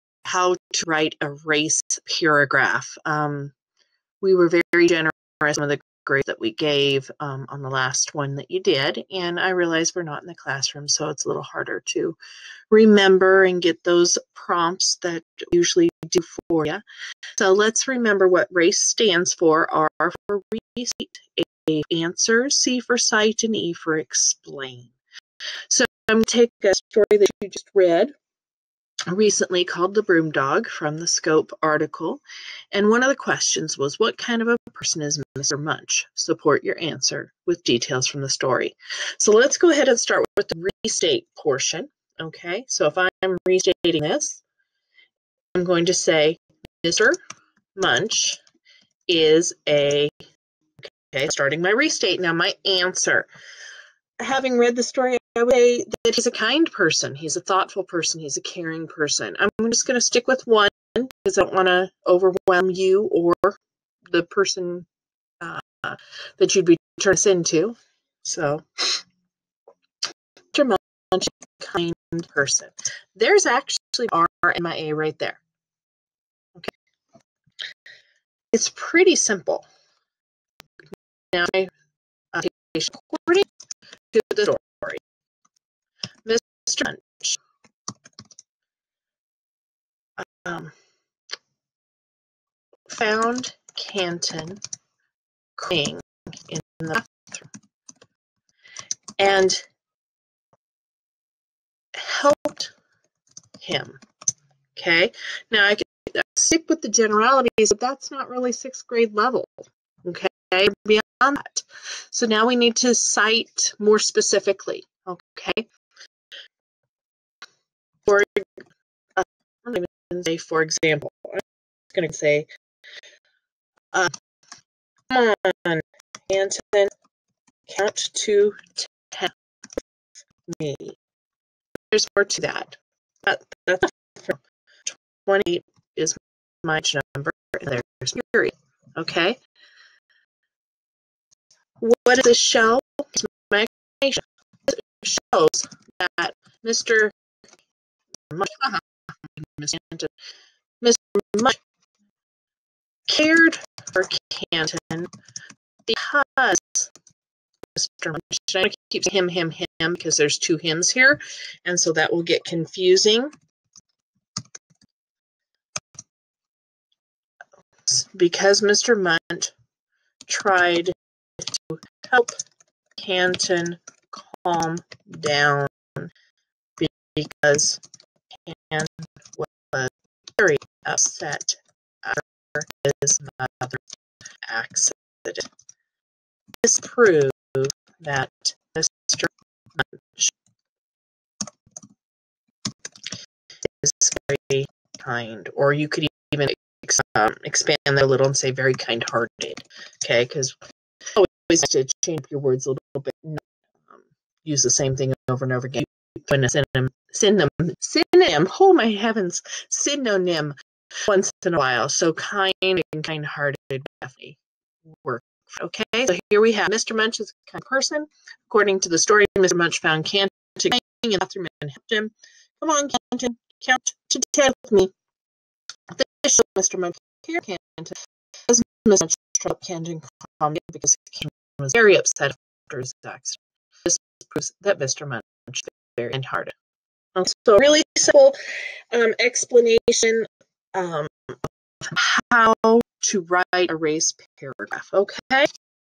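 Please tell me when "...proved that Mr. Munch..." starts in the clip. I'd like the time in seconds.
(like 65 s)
186 s.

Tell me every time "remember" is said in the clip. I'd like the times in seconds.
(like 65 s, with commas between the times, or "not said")
12 s, 17 s.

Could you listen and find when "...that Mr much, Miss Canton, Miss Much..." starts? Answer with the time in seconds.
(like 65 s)
146 s.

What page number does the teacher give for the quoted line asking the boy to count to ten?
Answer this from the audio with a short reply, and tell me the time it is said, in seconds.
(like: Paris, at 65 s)
28, at 135 s.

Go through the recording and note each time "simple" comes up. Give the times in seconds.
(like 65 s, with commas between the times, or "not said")
79 s, 237 s.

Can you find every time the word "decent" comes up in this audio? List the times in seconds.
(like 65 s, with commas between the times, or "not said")
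not said.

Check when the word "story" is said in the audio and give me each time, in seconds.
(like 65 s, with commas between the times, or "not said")
26 s, 38 s, 54 s, 84 s, 218 s.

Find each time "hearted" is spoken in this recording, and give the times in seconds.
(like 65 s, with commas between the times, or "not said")
198 s, 213 s, 236 s.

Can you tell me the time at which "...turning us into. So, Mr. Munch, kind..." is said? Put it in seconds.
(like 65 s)
66 s.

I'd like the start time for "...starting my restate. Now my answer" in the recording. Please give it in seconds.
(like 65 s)
51 s.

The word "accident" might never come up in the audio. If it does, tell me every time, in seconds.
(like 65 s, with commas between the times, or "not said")
184 s, 233 s.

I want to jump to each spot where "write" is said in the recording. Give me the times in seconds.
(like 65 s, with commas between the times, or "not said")
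0 s, 243 s.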